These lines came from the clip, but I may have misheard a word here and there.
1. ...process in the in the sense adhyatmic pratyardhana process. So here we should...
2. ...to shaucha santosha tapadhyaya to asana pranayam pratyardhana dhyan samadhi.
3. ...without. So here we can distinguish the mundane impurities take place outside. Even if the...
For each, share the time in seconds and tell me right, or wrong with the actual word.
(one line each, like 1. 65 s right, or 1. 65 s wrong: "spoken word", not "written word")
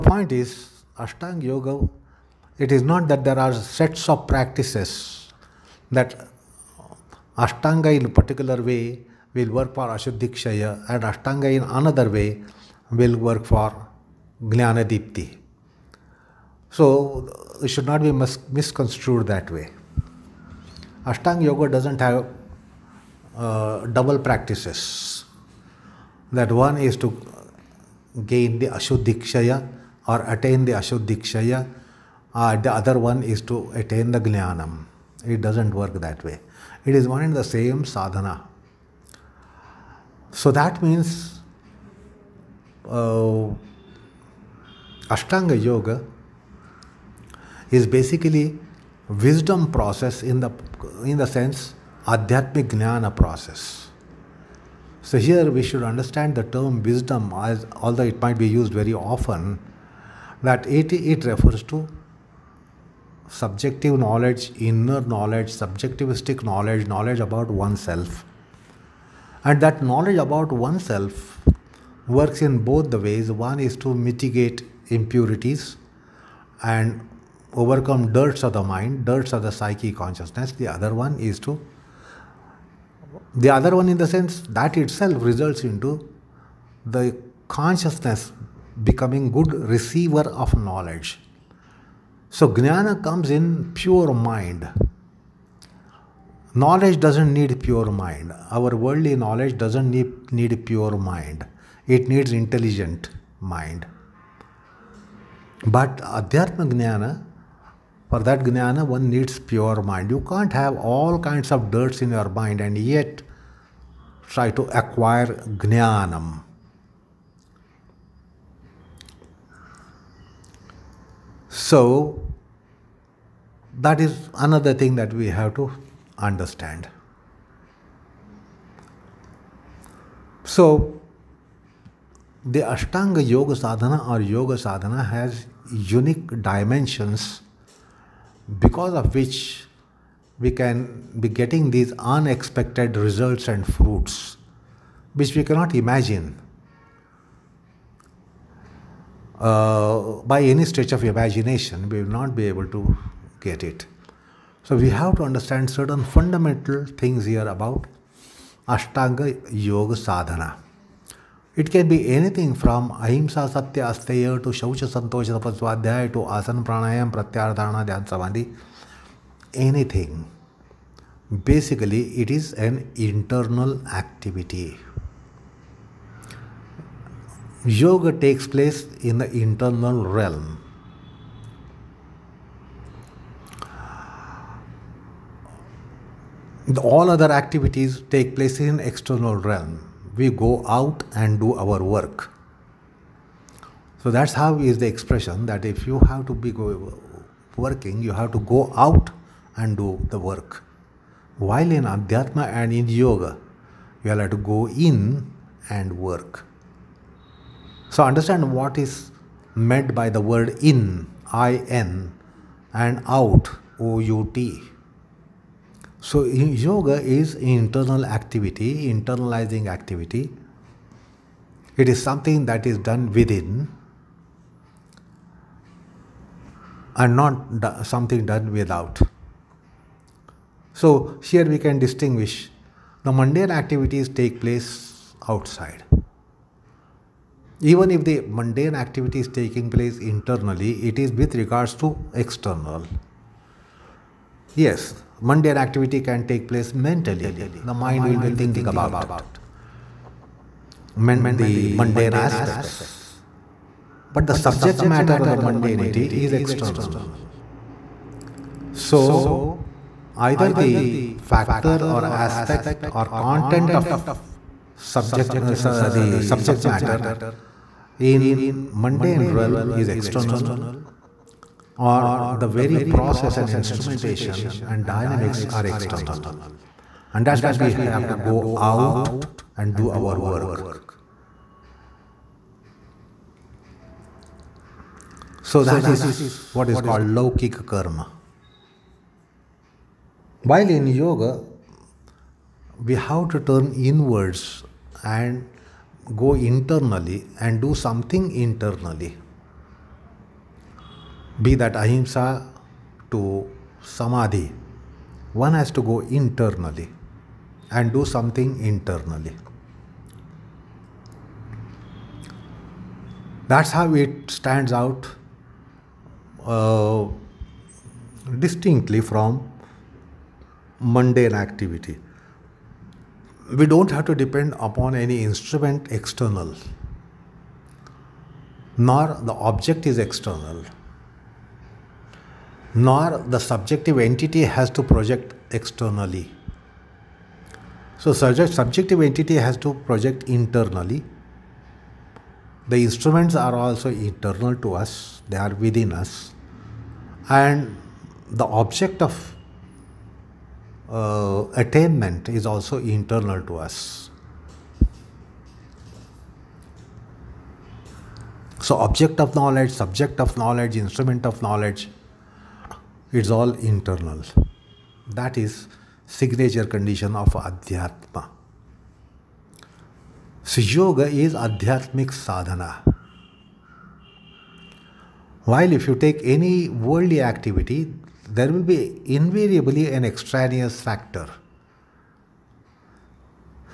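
1. 49 s wrong: "jnana", not "pratyardhana"
2. 164 s right
3. 228 s wrong: "activities", not "impurities".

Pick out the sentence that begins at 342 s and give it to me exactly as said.
The instruments are also internal to us, they are within us.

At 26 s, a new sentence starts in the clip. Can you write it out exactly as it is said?
That one is to gain the Ashuddhikshaya or attain the Ashuddhikshaya, uh, the other one is to attain the Jnanam.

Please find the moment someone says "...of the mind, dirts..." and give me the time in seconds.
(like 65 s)
78 s.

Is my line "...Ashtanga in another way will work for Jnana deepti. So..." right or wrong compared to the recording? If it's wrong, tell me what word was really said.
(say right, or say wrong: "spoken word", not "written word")
right.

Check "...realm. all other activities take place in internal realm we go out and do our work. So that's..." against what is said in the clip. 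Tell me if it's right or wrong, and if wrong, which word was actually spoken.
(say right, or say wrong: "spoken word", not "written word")
wrong: "external", not "internal".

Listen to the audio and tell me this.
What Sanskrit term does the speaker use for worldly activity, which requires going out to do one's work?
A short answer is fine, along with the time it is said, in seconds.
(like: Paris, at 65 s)
Laukika Karma, at 287 s.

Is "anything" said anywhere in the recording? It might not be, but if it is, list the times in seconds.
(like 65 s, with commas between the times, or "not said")
162 s, 169 s.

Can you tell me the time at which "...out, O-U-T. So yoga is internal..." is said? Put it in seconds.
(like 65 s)
213 s.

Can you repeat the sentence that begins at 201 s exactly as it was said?
While in Adhyatma and in Yoga, you are to go in and work.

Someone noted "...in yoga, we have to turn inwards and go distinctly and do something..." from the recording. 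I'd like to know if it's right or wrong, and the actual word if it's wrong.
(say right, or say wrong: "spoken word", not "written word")
wrong: "internally", not "distinctly".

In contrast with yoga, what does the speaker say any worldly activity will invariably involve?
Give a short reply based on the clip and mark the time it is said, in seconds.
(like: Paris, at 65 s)
an extraneous factor, at 380 s.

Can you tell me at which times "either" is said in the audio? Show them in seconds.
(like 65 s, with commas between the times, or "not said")
260 s.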